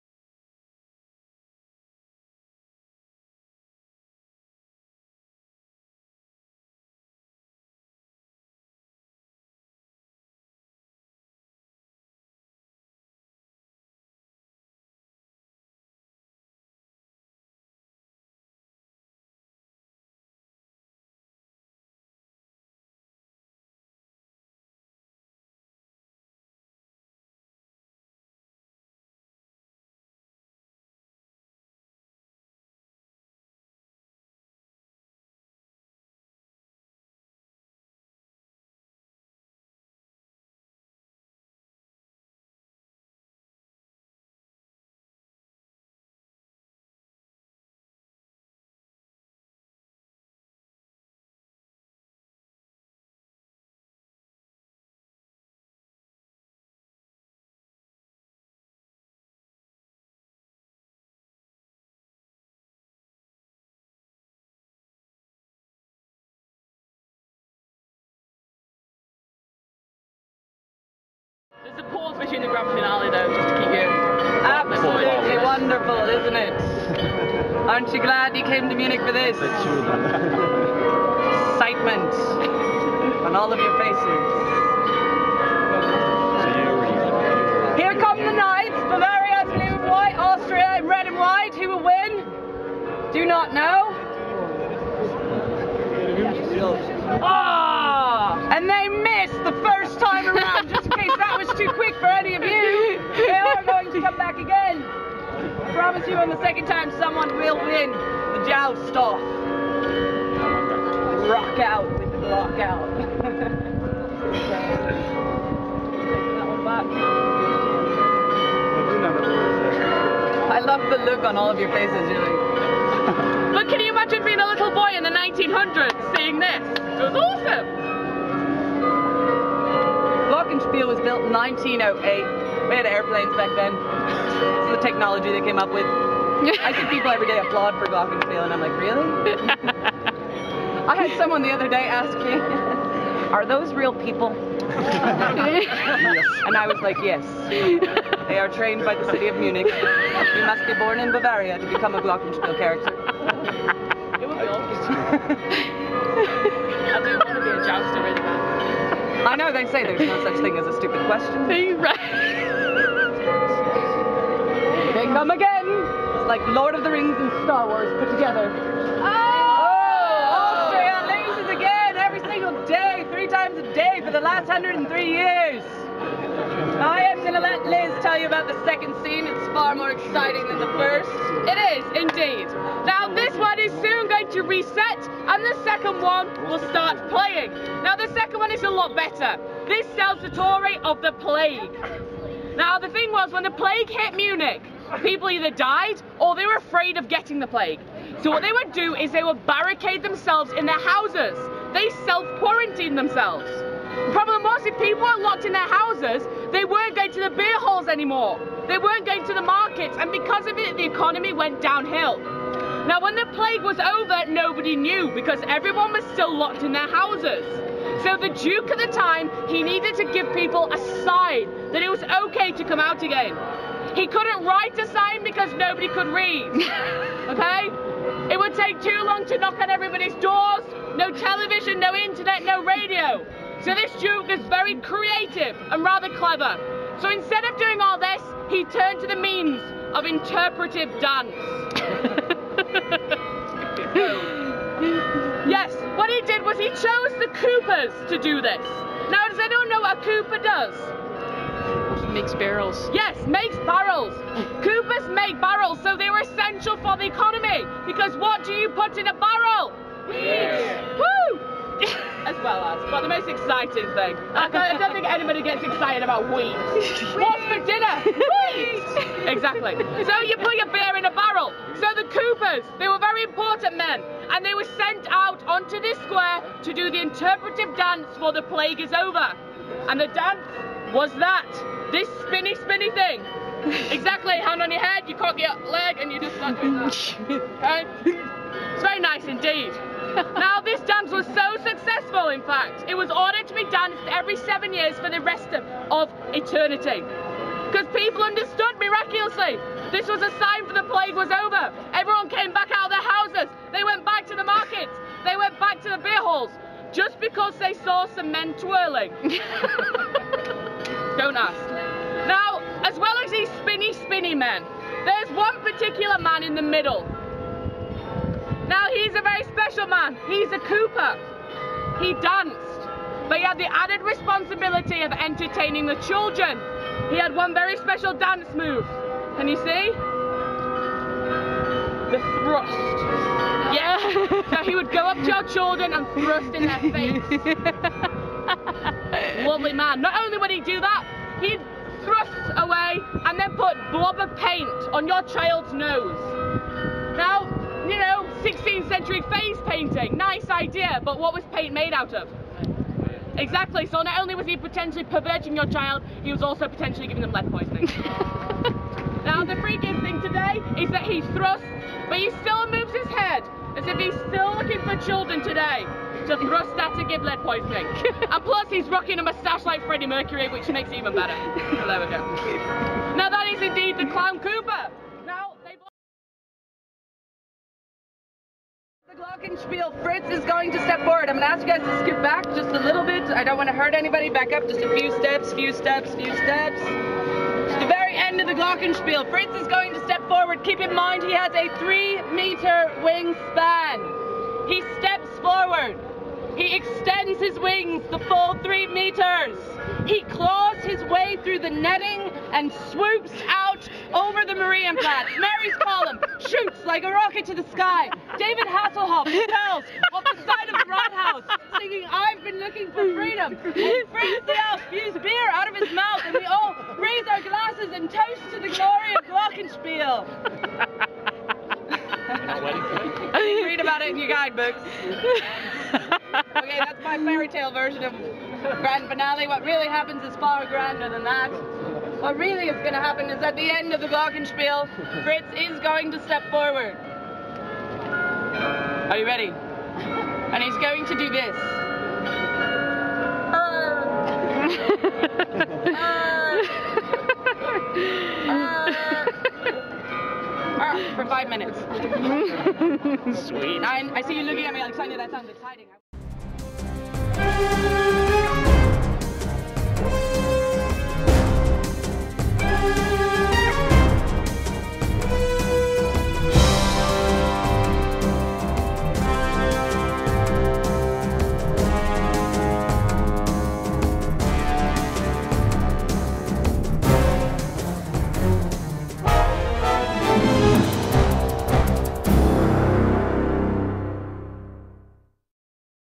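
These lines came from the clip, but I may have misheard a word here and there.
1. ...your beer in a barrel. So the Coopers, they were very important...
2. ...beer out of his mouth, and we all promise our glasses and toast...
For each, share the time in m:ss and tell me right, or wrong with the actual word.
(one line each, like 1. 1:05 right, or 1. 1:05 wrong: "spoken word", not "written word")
1. 4:30 right
2. 6:55 wrong: "raise", not "promise".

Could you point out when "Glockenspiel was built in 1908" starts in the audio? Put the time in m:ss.
2:10.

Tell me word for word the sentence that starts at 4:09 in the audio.
Now, does anyone know what a Cooper does?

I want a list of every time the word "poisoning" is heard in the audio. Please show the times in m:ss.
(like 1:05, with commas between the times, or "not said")
5:57, 6:07.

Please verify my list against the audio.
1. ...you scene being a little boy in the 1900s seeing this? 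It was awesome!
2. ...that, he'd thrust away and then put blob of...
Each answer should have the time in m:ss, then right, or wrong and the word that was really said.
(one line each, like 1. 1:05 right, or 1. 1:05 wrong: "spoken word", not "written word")
1. 2:03 wrong: "imagine", not "scene"
2. 5:40 right.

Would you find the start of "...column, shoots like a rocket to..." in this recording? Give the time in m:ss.
6:45.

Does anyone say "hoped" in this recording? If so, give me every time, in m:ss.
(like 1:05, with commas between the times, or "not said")
not said.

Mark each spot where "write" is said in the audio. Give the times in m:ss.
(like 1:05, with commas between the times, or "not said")
3:44.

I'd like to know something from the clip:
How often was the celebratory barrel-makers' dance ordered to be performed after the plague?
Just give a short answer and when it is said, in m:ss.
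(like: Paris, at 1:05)
Every 7 years, at 4:54.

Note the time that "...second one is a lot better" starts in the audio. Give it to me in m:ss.
3:08.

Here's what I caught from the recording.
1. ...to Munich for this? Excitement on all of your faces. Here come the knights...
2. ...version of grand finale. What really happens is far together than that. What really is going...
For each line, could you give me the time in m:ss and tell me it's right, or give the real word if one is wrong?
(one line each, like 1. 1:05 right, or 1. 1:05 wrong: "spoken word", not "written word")
1. 1:18 right
2. 7:07 wrong: "grander", not "together".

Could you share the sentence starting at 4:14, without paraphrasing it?
Coopers make barrels, so they were essential for the economy.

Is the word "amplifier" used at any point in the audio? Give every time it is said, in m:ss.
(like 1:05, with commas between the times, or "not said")
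not said.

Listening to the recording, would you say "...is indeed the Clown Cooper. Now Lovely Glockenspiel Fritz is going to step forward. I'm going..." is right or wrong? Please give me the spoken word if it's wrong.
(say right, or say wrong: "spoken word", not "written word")
wrong: "The", not "Lovely".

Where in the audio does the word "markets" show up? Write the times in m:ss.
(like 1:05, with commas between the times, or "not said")
3:29, 5:04.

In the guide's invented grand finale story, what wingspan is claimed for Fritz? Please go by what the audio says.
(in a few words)
3 meters.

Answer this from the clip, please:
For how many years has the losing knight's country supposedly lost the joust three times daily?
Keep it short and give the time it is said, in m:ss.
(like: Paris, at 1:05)
103, at 2:54.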